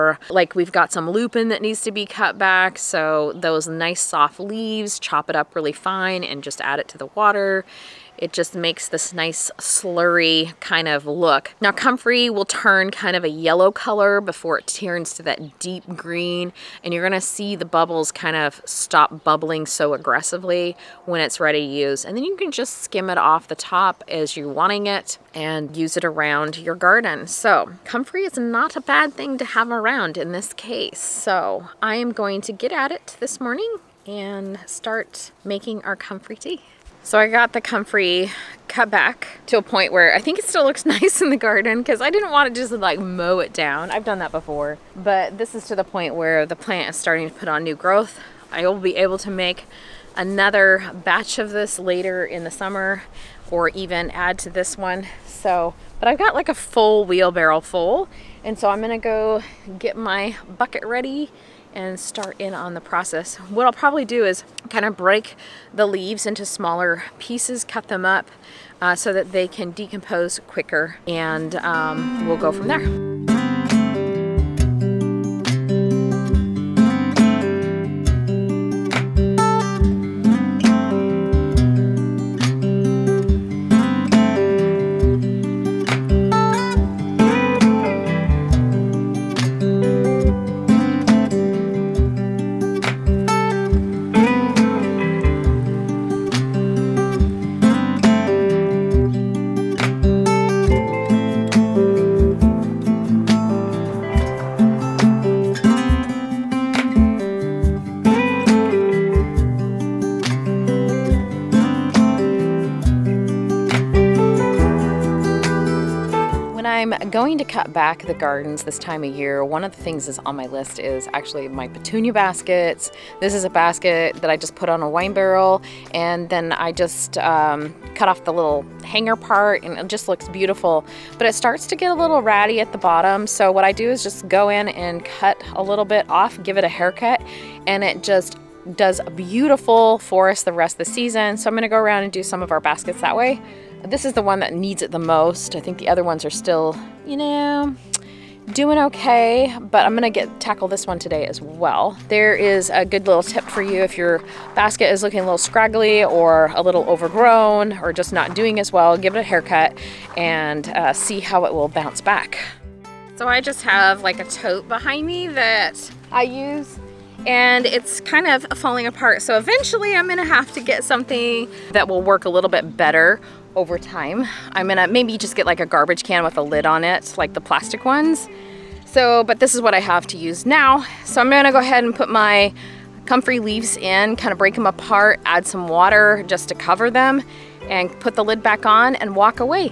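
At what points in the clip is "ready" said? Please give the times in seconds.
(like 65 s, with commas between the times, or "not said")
21 s, 60 s.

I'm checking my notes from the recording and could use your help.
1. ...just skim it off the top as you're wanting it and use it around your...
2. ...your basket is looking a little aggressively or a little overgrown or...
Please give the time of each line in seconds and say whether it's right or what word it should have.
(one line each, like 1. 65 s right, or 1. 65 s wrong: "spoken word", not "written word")
1. 22 s right
2. 153 s wrong: "scraggly", not "aggressively".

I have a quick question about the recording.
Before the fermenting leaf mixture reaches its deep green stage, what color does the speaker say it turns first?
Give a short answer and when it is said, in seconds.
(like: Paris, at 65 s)
yellow, at 13 s.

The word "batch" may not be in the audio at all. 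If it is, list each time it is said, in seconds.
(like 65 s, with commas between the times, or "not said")
51 s.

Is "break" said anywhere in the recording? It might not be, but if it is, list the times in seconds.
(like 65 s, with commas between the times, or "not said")
64 s, 184 s.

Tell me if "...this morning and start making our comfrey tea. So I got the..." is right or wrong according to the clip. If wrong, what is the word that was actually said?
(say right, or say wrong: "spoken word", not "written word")
right.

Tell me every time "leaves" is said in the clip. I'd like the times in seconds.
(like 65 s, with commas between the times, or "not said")
4 s, 65 s, 183 s.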